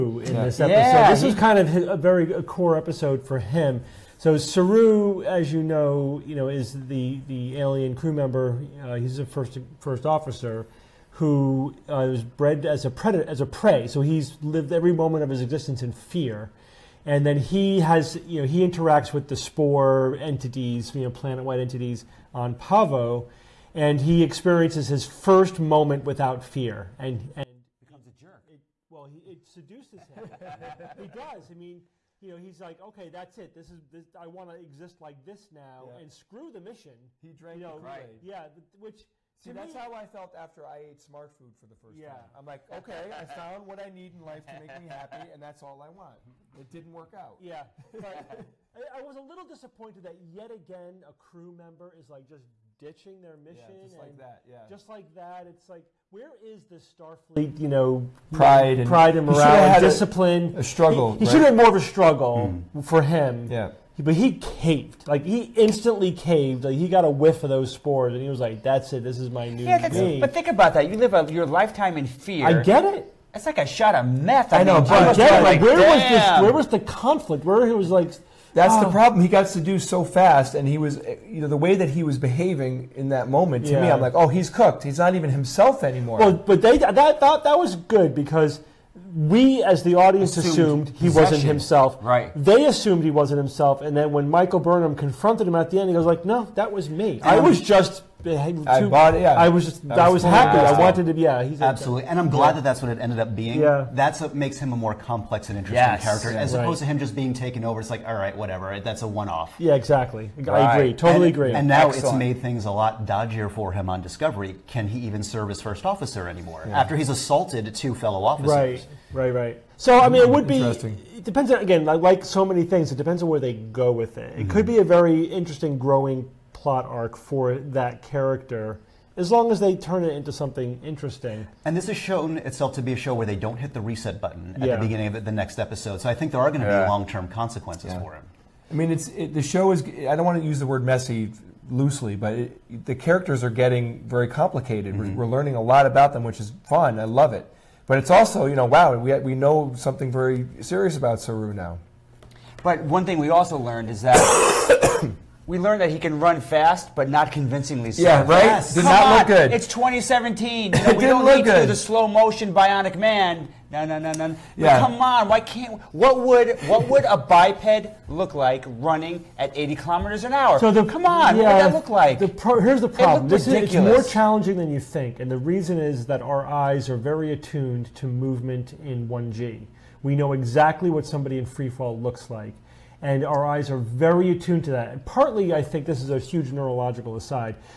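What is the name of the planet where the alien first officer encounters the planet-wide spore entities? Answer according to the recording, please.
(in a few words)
Pahvo.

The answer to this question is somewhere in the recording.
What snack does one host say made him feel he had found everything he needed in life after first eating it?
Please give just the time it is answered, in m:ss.
0:40.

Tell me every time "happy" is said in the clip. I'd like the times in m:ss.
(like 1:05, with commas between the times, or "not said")
0:44, 1:40.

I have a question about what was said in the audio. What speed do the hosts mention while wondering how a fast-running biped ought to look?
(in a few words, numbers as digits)
80 kilometers an hour.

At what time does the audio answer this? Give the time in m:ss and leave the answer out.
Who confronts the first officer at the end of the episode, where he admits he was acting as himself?
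1:34.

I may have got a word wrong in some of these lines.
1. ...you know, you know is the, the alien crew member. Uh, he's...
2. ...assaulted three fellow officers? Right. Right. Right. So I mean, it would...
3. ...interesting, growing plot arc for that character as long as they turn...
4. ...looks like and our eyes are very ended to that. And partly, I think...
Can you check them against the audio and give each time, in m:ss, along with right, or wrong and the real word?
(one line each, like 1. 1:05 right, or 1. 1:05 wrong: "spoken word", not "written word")
1. 0:05 right
2. 1:57 wrong: "two", not "three"
3. 2:05 right
4. 3:01 wrong: "attuned", not "ended".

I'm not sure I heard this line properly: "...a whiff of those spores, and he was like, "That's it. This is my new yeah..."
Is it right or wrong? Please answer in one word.
right.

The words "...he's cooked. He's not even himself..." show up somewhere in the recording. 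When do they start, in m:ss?
1:24.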